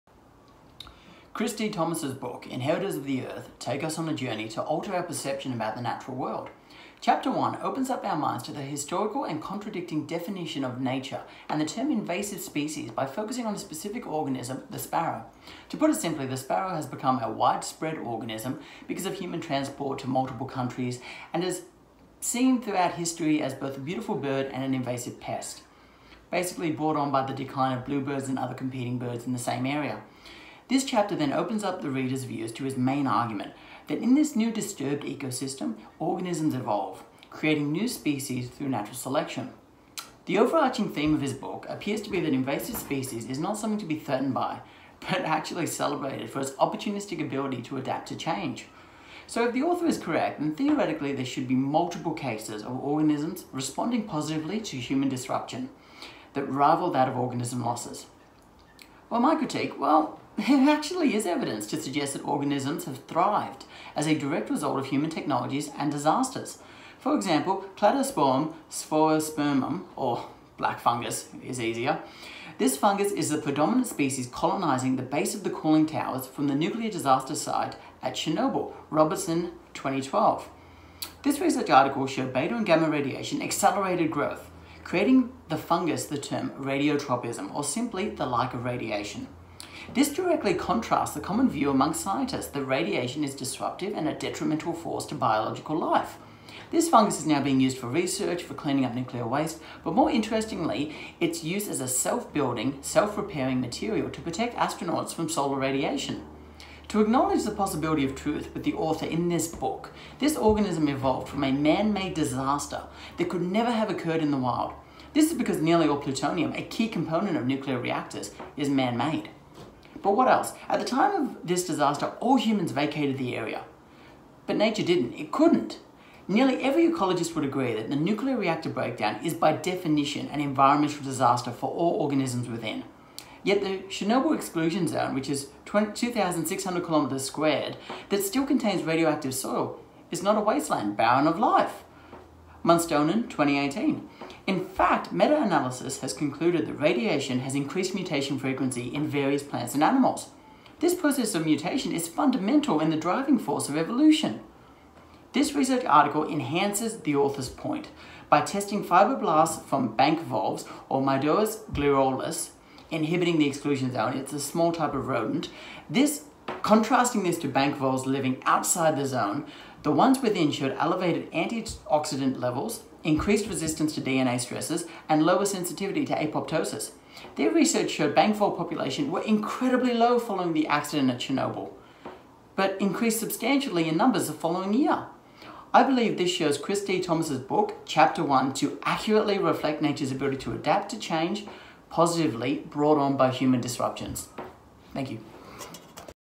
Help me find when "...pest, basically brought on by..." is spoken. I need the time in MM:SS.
00:25.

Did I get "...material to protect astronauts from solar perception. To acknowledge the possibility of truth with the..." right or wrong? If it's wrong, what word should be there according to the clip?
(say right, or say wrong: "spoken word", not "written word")
wrong: "radiation", not "perception".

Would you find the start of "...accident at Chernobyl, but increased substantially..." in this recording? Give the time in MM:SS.
03:00.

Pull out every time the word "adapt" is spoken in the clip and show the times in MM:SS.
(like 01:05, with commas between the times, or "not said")
00:47, 03:10.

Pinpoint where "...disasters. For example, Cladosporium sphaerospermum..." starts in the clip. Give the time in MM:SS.
01:05.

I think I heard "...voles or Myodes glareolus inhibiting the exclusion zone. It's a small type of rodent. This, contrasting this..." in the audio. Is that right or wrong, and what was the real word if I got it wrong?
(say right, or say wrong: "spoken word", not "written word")
right.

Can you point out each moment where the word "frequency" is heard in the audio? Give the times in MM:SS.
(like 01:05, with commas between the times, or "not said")
02:28.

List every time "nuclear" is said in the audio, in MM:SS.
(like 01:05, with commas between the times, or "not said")
01:16, 01:38, 01:57, 02:07.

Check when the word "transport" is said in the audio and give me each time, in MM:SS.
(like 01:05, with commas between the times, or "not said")
00:19.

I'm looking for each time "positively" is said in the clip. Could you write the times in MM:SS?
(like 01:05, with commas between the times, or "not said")
00:54, 03:11.